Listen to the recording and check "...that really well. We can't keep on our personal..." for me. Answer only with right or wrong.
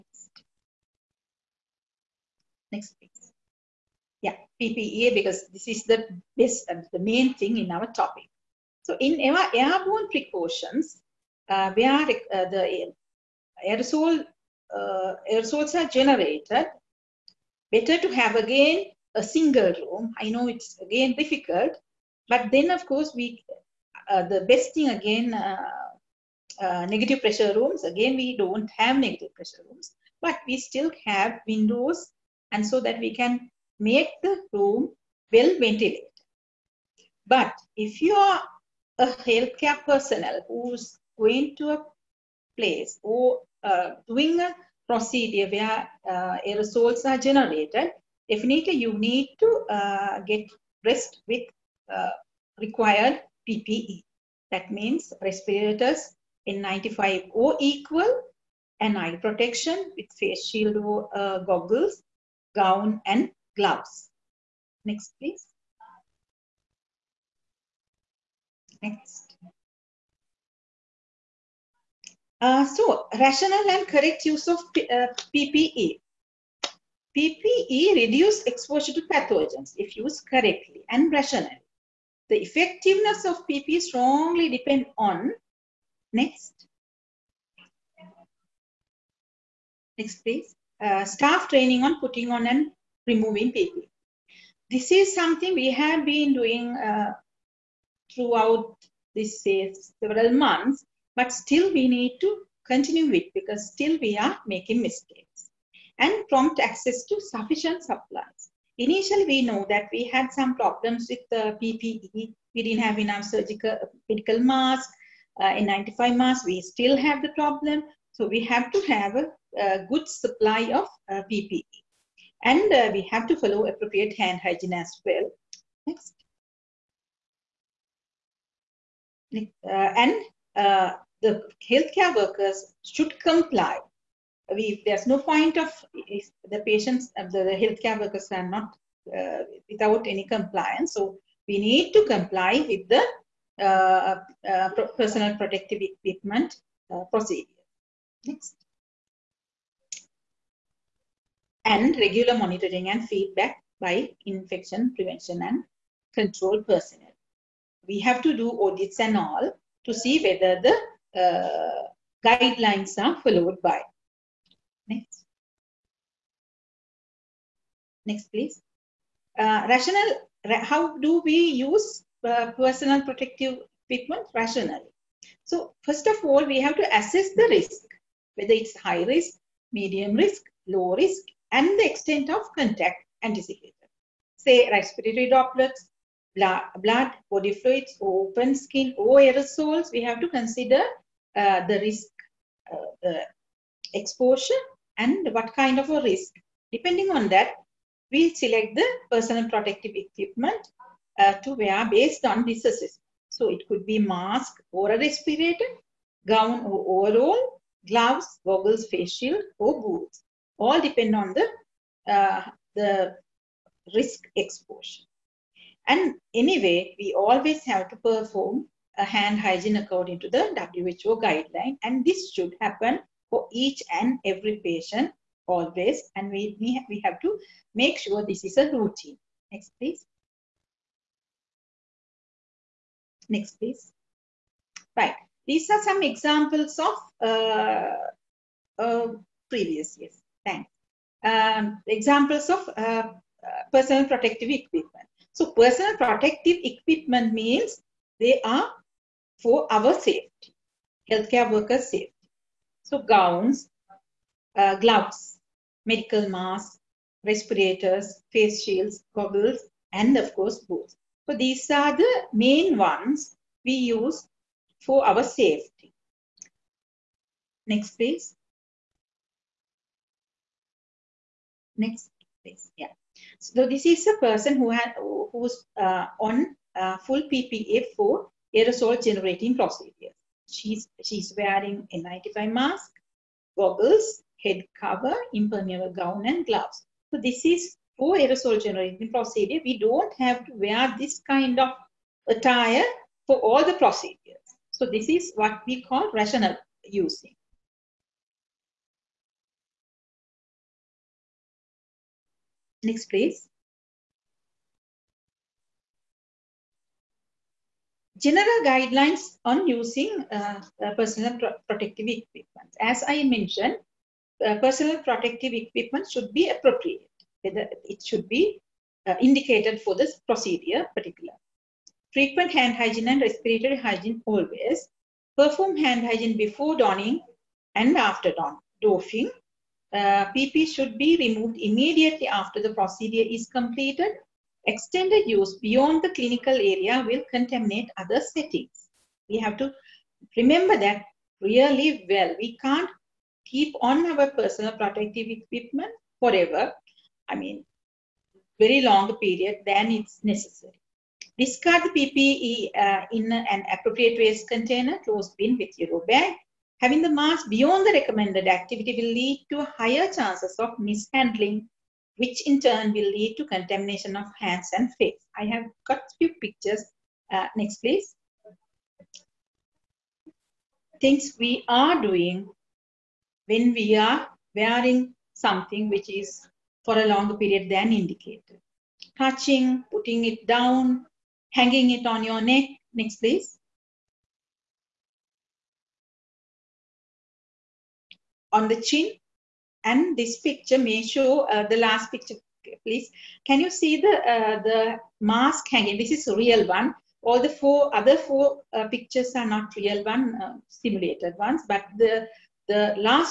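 right.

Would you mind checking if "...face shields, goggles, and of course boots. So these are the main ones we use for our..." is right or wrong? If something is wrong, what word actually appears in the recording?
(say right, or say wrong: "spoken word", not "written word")
right.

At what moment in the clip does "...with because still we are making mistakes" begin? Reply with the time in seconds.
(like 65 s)
103 s.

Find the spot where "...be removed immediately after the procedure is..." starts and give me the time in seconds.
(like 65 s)
330 s.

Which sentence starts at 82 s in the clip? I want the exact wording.
The effectiveness of PP strongly depend on, next, next please, uh, staff training on putting on and removing PP.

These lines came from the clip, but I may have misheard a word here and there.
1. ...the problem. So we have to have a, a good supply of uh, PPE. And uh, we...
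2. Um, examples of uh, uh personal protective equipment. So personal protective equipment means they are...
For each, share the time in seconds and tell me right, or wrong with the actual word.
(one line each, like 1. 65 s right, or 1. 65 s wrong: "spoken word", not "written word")
1. 117 s right
2. 241 s right.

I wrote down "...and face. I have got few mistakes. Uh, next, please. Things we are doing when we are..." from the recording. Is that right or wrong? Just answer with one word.
wrong.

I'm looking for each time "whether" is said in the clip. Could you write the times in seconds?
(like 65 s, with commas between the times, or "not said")
160 s, 178 s, 317 s.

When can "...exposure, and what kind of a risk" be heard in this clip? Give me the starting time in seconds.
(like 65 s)
193 s.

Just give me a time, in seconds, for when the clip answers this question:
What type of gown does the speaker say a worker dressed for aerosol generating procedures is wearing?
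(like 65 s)
285 s.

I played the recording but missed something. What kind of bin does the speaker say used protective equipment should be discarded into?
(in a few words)
Closed bin.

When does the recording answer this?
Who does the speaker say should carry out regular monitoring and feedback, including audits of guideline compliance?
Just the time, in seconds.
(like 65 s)
154 s.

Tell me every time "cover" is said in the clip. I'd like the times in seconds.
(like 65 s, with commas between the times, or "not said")
284 s.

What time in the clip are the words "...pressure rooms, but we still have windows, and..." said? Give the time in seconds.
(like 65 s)
29 s.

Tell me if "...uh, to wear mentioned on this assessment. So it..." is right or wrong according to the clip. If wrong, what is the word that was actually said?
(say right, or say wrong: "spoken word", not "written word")
wrong: "based", not "mentioned".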